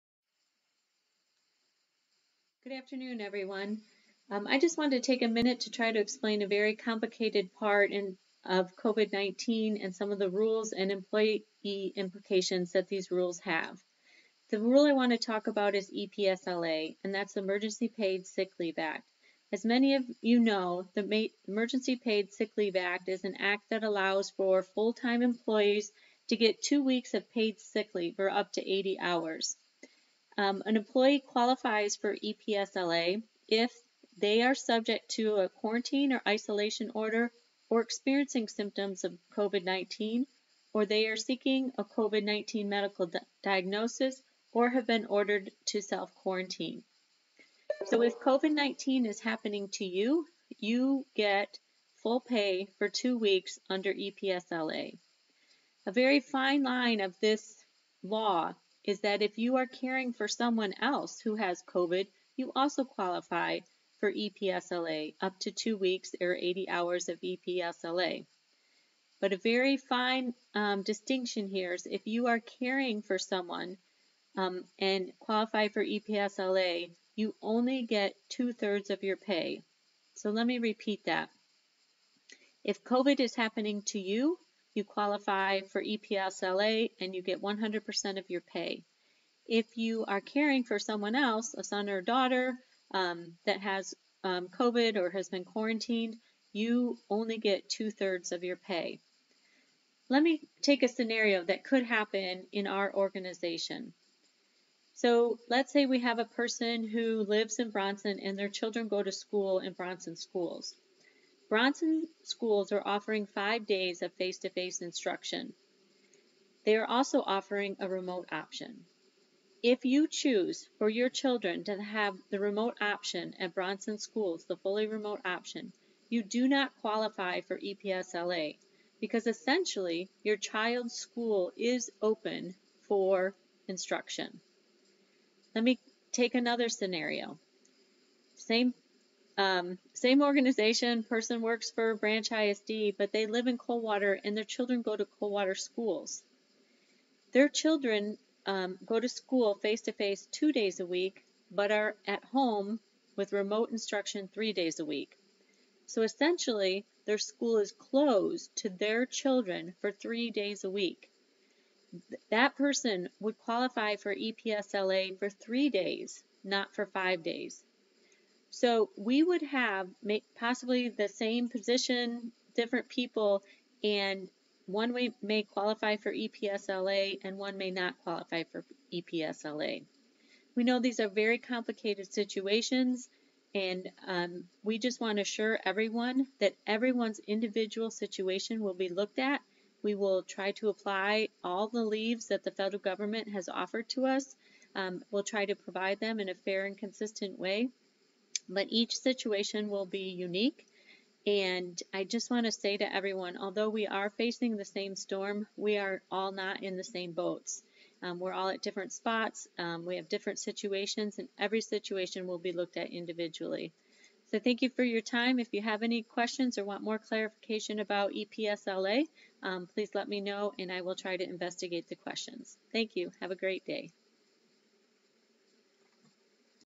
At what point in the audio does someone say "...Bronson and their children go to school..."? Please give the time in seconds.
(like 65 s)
107 s.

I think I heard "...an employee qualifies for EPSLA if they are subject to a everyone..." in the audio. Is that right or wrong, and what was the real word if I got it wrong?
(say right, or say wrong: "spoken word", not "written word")
wrong: "quarantine", not "everyone".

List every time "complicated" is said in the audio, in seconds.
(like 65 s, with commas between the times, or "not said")
6 s, 181 s.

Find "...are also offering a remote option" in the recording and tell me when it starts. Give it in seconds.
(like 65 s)
116 s.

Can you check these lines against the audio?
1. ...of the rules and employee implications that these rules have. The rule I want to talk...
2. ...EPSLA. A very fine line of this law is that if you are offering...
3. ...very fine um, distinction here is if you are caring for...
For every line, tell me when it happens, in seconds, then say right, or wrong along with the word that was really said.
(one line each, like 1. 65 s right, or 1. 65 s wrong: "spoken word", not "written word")
1. 10 s right
2. 53 s wrong: "caring", not "offering"
3. 69 s right.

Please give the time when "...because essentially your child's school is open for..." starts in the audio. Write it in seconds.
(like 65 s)
129 s.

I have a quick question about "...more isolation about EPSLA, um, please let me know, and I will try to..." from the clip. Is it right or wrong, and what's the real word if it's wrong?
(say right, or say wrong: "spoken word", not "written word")
wrong: "clarification", not "isolation".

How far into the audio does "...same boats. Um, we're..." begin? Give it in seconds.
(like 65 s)
206 s.